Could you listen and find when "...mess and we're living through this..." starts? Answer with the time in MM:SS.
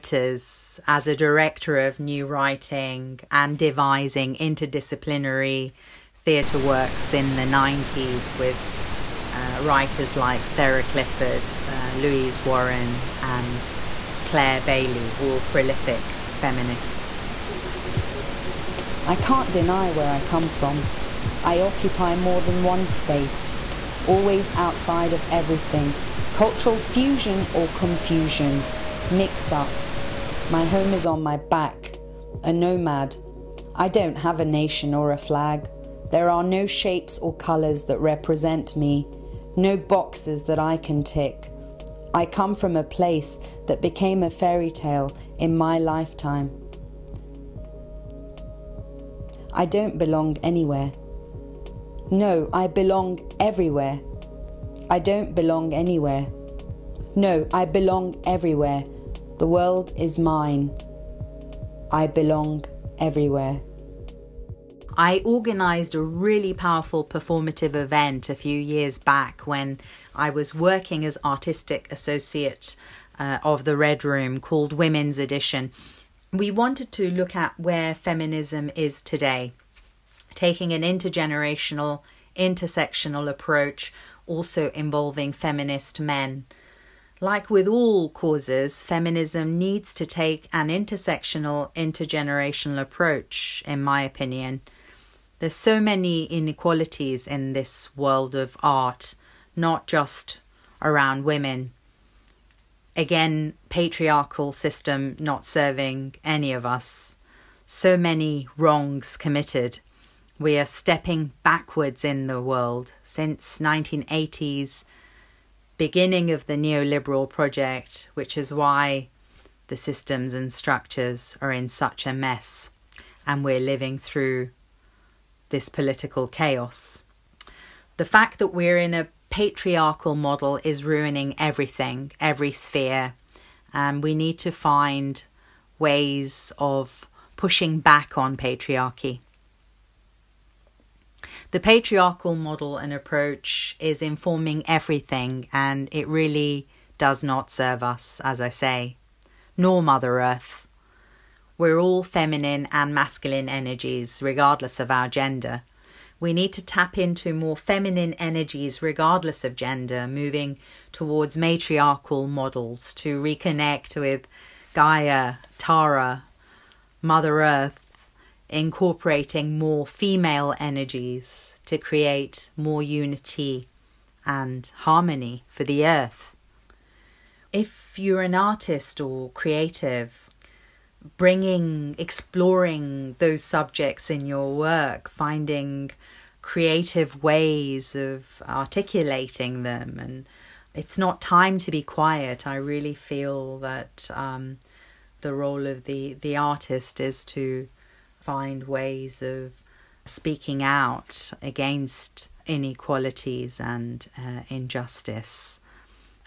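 02:02.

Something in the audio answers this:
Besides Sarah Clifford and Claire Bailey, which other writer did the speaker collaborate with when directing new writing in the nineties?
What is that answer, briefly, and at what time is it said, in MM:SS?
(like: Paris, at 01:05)
Louise Warren, at 00:11.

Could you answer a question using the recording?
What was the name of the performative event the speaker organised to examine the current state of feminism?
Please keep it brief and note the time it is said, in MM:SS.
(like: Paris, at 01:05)
Women's Edition, at 01:14.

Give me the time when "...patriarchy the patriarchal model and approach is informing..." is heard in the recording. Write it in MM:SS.
02:18.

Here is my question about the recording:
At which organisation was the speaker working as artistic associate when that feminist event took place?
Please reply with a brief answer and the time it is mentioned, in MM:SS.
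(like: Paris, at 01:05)
the Red Room, at 01:13.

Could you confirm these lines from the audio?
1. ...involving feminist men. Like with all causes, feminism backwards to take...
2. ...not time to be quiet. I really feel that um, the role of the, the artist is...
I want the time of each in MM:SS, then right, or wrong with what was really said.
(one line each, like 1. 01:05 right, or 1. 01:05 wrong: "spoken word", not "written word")
1. 01:24 wrong: "needs", not "backwards"
2. 03:10 right.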